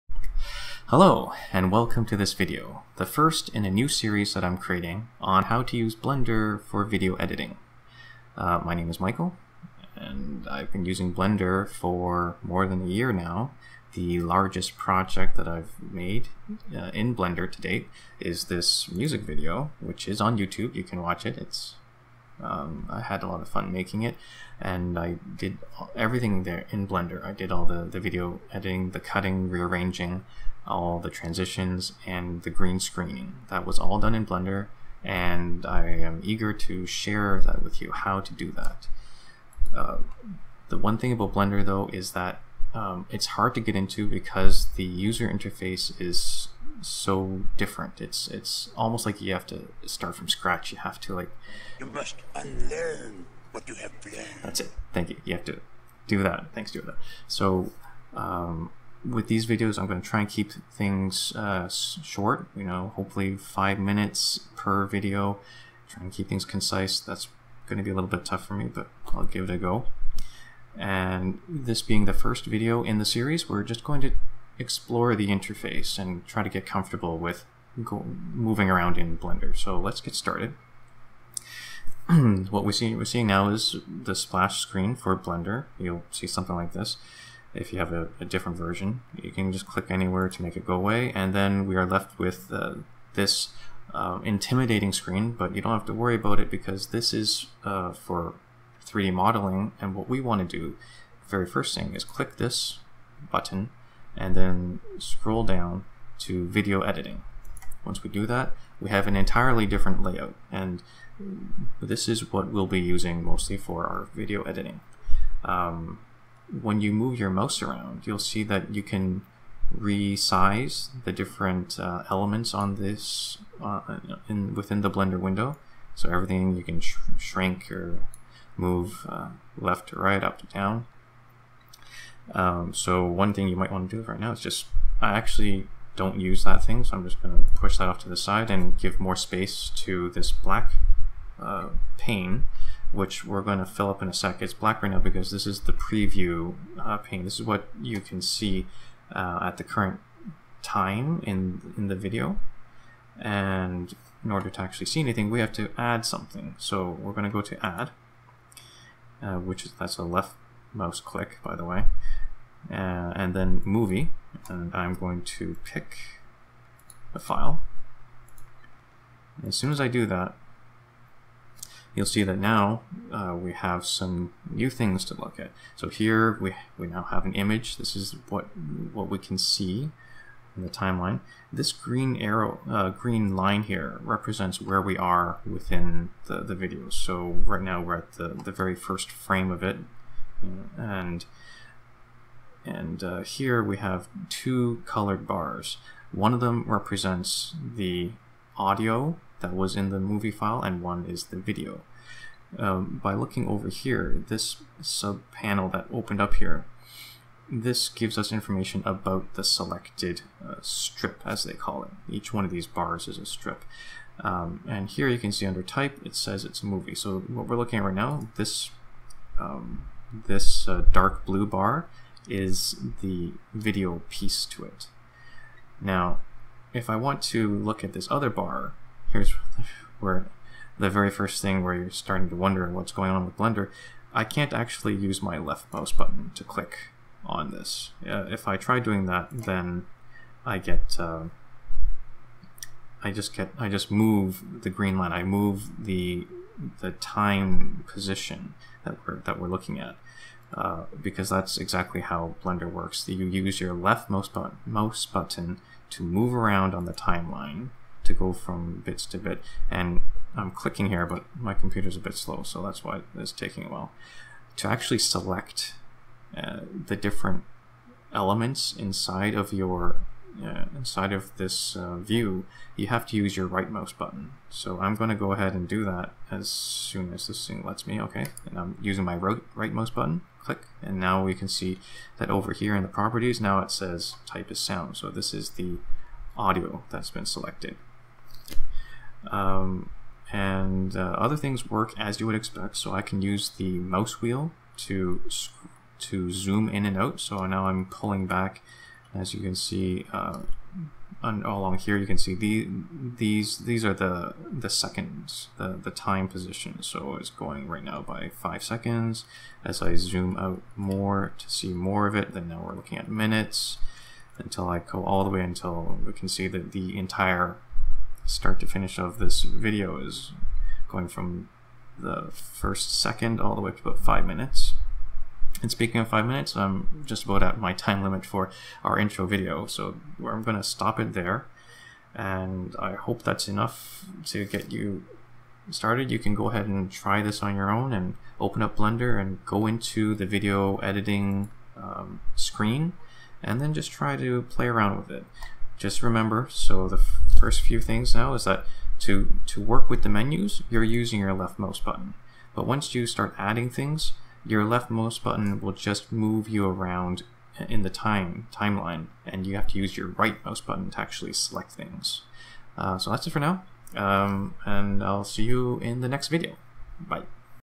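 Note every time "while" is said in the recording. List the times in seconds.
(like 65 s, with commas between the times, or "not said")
263 s.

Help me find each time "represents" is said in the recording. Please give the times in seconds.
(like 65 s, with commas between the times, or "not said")
184 s, 196 s.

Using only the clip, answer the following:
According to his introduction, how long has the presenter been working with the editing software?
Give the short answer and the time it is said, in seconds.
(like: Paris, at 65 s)
more than a year, at 12 s.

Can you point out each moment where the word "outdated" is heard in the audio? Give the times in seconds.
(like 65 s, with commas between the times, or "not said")
not said.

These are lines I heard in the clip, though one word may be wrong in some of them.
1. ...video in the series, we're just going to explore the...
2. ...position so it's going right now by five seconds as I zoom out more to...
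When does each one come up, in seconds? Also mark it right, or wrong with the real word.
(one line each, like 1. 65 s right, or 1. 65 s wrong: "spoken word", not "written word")
1. 72 s right
2. 306 s right.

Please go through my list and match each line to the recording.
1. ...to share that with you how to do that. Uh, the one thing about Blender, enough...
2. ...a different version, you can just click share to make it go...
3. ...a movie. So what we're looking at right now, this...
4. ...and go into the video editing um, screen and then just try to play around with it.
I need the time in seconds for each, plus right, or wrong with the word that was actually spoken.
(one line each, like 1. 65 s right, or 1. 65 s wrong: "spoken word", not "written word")
1. 36 s wrong: "though", not "enough"
2. 88 s wrong: "anywhere", not "share"
3. 216 s right
4. 339 s right.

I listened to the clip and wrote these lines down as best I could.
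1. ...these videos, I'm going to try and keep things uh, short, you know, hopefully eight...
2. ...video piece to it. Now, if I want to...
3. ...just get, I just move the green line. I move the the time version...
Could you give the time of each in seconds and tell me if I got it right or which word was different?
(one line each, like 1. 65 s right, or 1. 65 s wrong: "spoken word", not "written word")
1. 59 s wrong: "five", not "eight"
2. 223 s right
3. 243 s wrong: "position", not "version".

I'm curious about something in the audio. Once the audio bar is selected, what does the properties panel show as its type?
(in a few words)
sound.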